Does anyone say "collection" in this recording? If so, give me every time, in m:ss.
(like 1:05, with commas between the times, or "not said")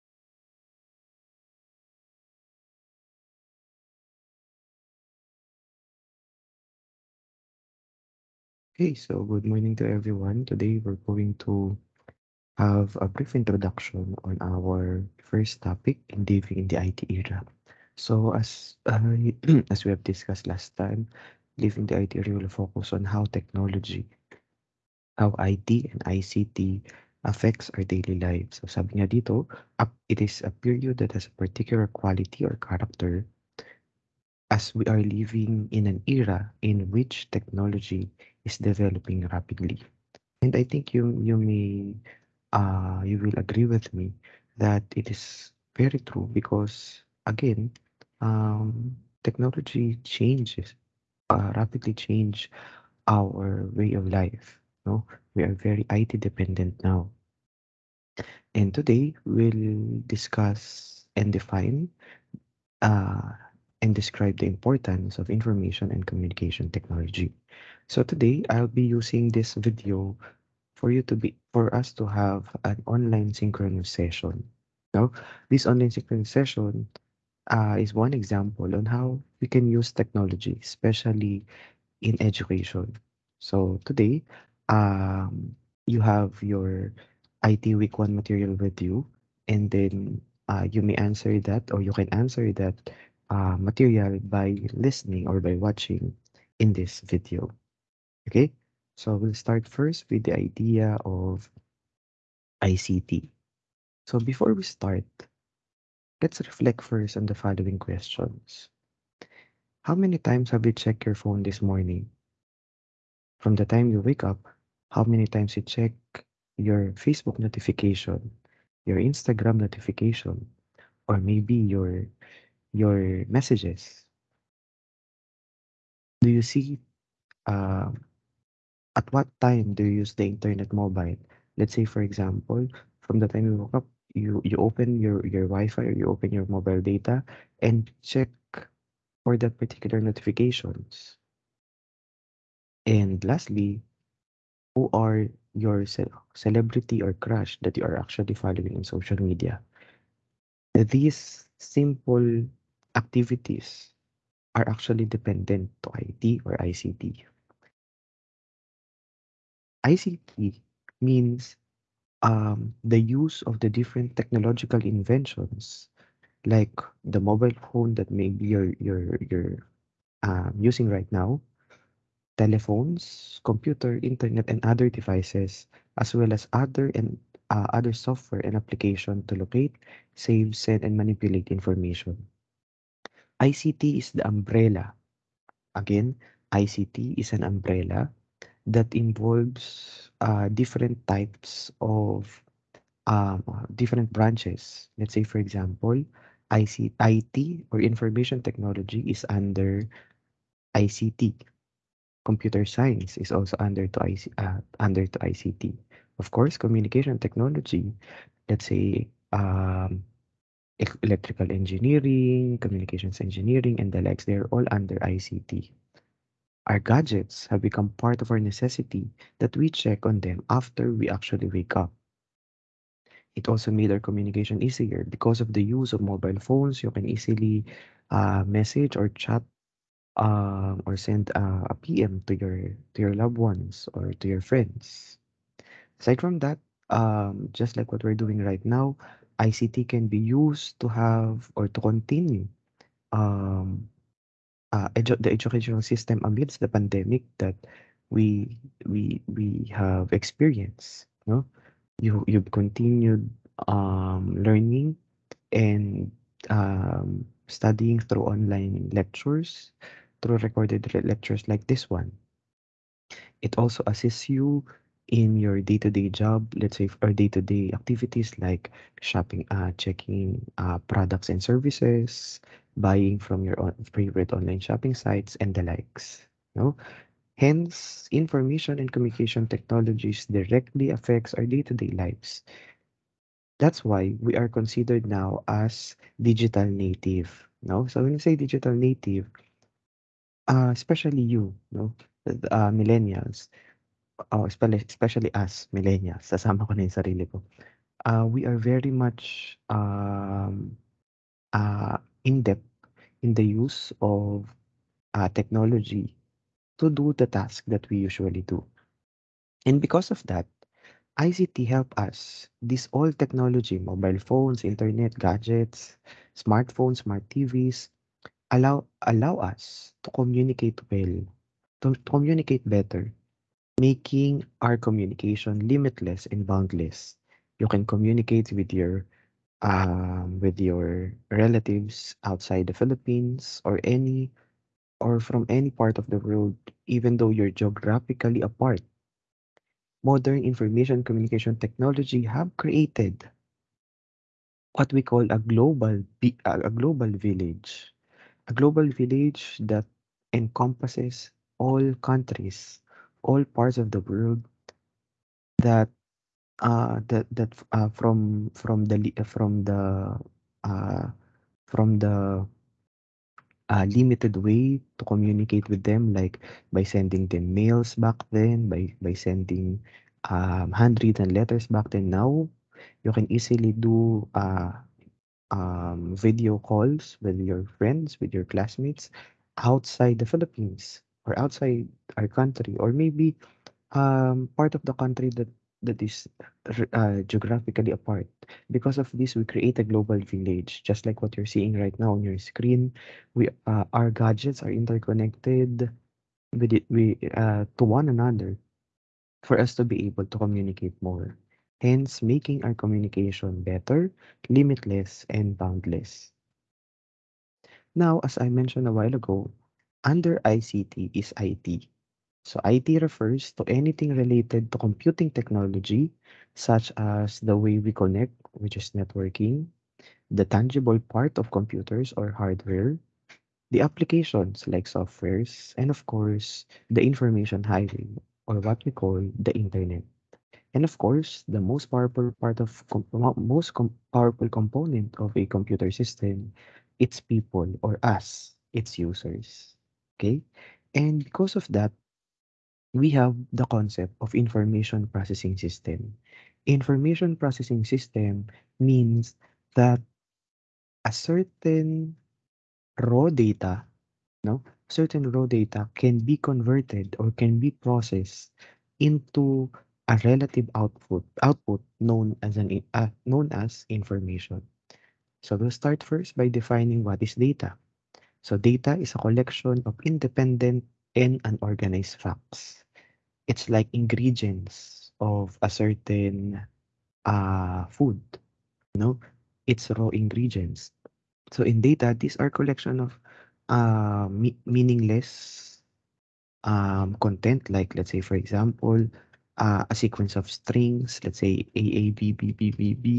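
7:49, 8:02.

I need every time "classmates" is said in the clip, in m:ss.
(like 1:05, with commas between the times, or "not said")
6:18.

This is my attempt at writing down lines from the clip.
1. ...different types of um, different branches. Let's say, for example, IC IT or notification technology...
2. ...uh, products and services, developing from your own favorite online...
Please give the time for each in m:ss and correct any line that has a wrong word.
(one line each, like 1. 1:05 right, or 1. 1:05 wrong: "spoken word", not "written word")
1. 3:10 wrong: "information", not "notification"
2. 4:30 wrong: "buying", not "developing".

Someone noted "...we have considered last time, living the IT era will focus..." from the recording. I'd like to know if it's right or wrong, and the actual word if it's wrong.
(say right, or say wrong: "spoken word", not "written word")
wrong: "discussed", not "considered".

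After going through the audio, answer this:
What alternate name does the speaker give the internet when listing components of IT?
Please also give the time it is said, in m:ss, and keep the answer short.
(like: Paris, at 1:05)
information highway, at 7:07.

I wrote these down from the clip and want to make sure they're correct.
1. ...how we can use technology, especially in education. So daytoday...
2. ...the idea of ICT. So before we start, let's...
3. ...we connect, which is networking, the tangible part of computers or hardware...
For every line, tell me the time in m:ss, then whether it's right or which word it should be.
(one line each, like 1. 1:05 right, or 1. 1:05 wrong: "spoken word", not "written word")
1. 1:18 wrong: "today", not "daytoday"
2. 1:40 right
3. 6:57 right.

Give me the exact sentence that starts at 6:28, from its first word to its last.
Because of this, we create a global village, just like what you're seeing right now on your screen.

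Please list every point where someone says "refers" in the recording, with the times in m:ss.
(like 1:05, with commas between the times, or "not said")
6:53.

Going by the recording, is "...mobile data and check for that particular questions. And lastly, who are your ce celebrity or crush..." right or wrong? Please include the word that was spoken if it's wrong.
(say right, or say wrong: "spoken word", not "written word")
wrong: "notifications", not "questions".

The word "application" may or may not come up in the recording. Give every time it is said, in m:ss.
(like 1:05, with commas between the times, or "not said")
2:58, 7:03.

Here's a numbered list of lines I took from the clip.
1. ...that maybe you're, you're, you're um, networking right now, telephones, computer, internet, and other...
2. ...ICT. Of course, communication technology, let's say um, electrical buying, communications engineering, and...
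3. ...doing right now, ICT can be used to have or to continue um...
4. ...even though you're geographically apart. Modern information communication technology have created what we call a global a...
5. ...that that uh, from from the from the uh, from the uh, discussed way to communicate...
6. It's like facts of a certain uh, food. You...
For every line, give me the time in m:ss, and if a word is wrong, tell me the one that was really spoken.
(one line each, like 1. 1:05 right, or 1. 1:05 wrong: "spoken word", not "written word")
1. 2:47 wrong: "using", not "networking"
2. 3:25 wrong: "engineering", not "buying"
3. 3:58 right
4. 5:36 right
5. 5:57 wrong: "limited", not "discussed"
6. 7:53 wrong: "ingredients", not "facts".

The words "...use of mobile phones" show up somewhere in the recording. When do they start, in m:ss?
3:45.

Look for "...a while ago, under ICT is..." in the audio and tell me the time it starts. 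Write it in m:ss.
6:48.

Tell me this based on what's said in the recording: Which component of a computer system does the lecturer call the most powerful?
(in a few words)
people.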